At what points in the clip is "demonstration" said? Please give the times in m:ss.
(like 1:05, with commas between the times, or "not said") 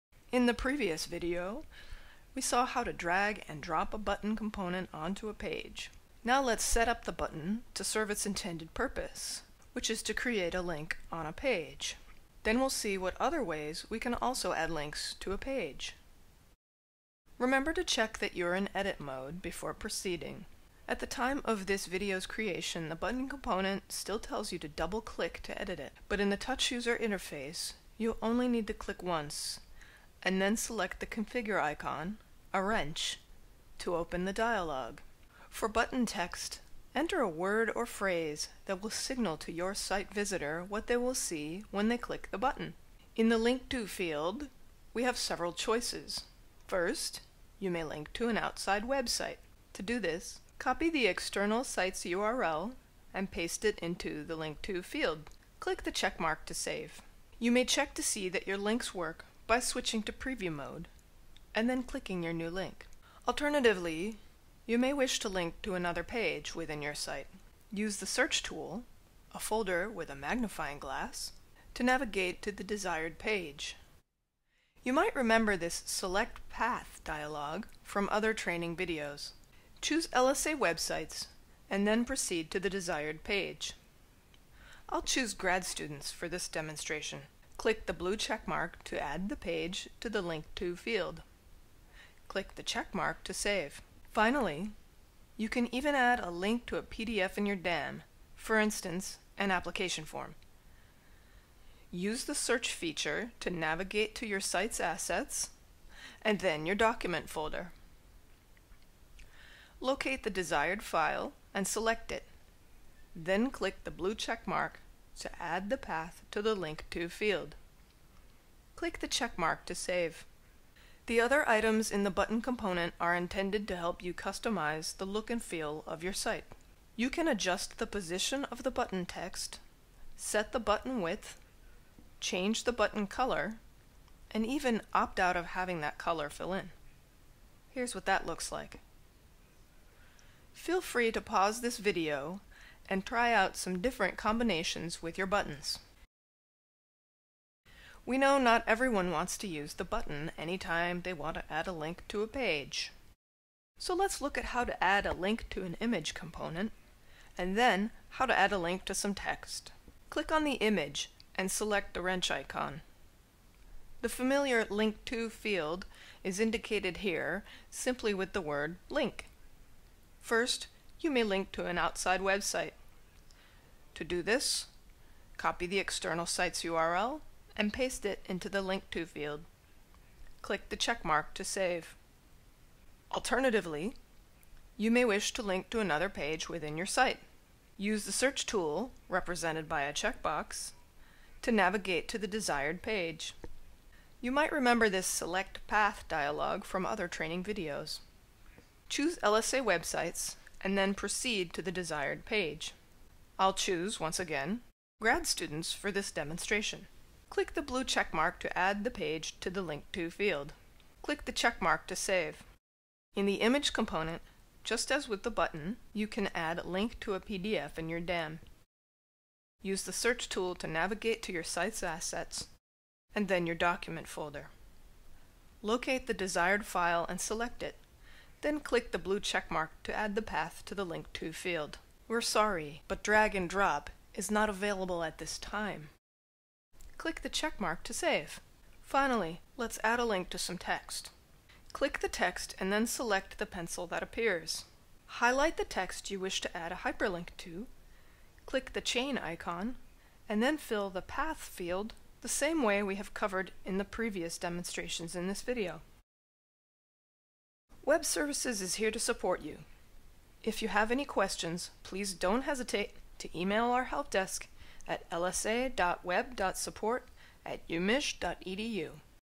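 1:26, 3:26, 4:14.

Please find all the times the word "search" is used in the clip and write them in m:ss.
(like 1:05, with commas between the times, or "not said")
1:08, 1:42, 3:08, 3:39.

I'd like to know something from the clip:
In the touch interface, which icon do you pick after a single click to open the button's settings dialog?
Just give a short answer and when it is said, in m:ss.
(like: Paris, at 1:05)
a wrench, at 0:32.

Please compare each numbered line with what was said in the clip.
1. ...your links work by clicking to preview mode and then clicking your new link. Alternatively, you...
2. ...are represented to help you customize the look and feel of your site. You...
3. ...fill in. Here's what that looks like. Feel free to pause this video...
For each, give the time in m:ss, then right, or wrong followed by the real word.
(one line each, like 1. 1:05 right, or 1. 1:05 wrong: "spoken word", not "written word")
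1. 0:58 wrong: "switching", not "clicking"
2. 2:02 wrong: "intended", not "represented"
3. 2:16 right.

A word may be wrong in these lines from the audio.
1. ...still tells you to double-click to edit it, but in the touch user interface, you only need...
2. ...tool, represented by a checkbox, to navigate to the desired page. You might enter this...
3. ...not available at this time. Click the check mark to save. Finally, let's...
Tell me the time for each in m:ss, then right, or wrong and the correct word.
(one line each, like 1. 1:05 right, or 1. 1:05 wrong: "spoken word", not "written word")
1. 0:23 right
2. 3:08 wrong: "remember", not "enter"
3. 3:54 right.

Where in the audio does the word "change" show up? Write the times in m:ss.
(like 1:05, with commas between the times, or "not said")
2:12.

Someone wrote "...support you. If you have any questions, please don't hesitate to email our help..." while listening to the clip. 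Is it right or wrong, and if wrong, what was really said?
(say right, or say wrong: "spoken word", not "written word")
right.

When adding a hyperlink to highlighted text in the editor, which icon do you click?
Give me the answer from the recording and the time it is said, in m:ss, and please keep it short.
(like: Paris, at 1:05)
the chain icon, at 4:08.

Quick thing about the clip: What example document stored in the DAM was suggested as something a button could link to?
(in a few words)
an application form.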